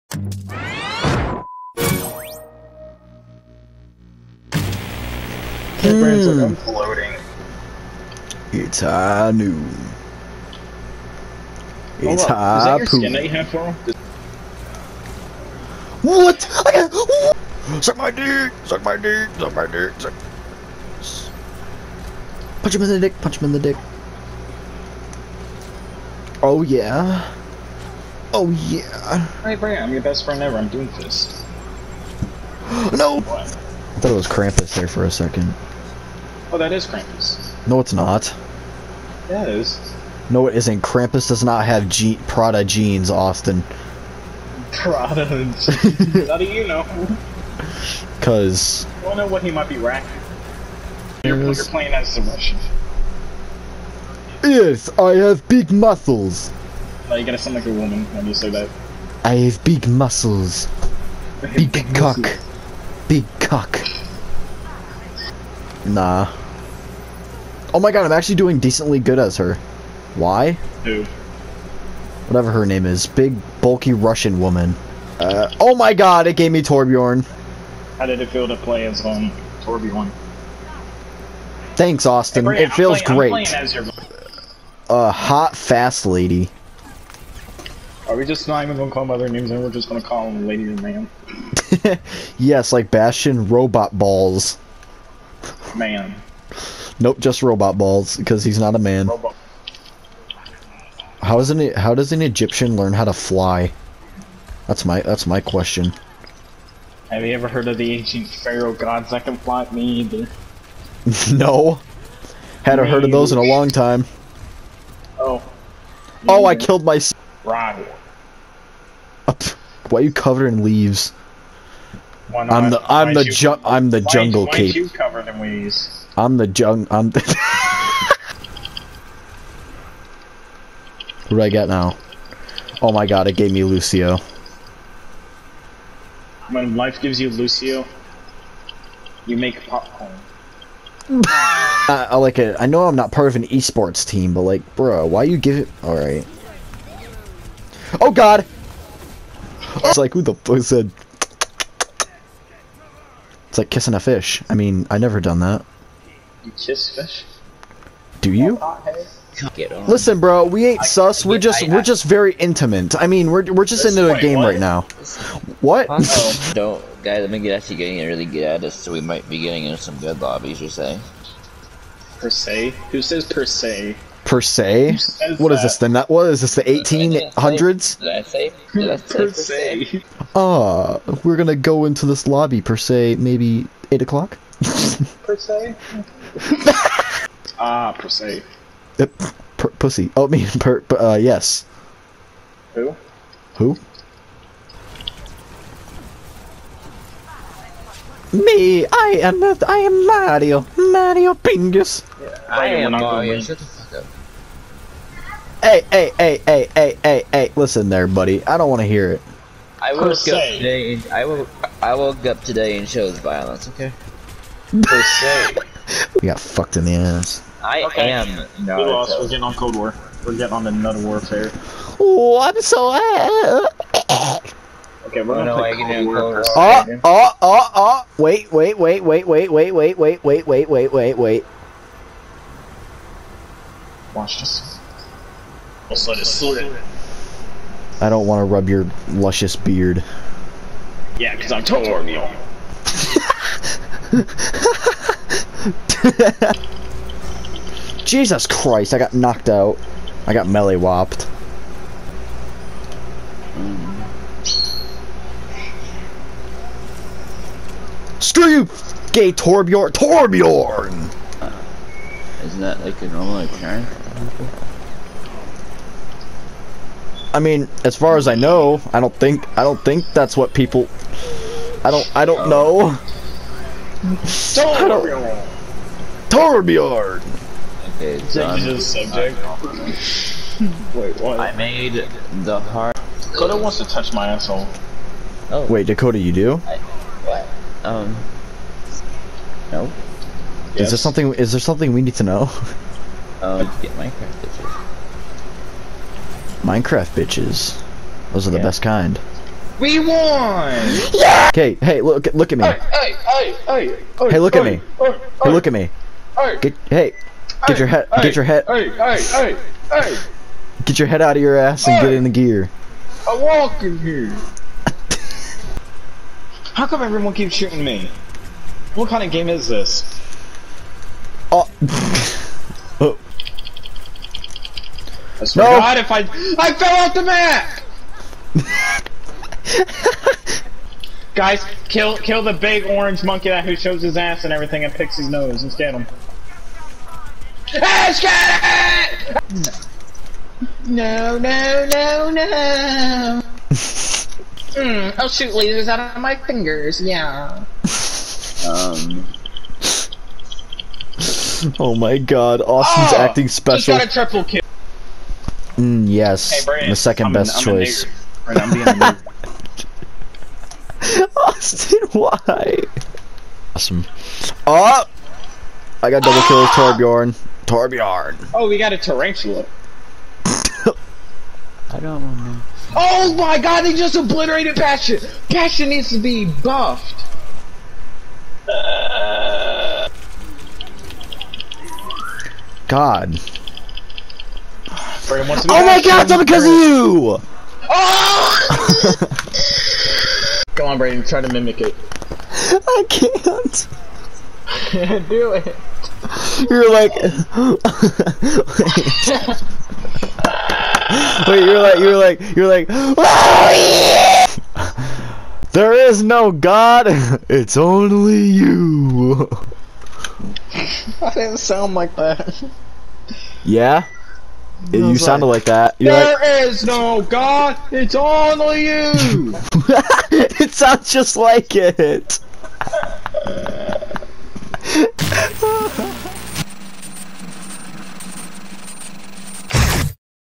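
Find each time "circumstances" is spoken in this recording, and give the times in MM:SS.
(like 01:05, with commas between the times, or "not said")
not said.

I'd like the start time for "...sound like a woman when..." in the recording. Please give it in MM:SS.
00:57.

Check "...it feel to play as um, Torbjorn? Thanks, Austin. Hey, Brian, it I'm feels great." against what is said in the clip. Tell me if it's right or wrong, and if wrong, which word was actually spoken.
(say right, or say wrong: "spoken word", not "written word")
right.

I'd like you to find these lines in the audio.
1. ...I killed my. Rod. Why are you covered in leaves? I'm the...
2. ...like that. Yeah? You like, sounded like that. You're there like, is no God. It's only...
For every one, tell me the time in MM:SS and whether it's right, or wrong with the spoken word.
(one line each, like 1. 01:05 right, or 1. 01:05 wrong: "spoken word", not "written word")
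1. 01:56 right
2. 06:51 right.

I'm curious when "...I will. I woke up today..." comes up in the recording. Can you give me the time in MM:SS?
03:31.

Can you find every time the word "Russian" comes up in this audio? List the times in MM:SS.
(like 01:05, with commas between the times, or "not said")
00:52, 01:13.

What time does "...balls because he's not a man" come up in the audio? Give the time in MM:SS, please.
01:37.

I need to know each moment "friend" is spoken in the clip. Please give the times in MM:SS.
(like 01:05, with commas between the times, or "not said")
00:30.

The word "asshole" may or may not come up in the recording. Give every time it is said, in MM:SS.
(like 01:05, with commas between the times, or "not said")
04:44.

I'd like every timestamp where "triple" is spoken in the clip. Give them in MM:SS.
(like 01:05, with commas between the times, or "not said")
05:54.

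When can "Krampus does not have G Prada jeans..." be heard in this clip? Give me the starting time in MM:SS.
00:40.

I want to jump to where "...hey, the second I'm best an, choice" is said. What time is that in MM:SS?
05:56.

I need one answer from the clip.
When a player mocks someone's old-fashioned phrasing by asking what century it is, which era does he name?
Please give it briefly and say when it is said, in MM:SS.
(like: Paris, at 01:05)
The eighteen hundreds, at 02:56.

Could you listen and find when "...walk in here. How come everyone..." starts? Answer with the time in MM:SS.
05:13.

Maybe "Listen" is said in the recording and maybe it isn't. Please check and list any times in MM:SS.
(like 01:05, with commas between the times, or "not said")
02:39, 03:27.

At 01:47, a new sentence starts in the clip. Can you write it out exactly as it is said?
Have you ever heard of the ancient pharaoh gods that can fly?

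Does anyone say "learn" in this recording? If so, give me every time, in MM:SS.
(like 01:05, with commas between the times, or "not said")
01:42.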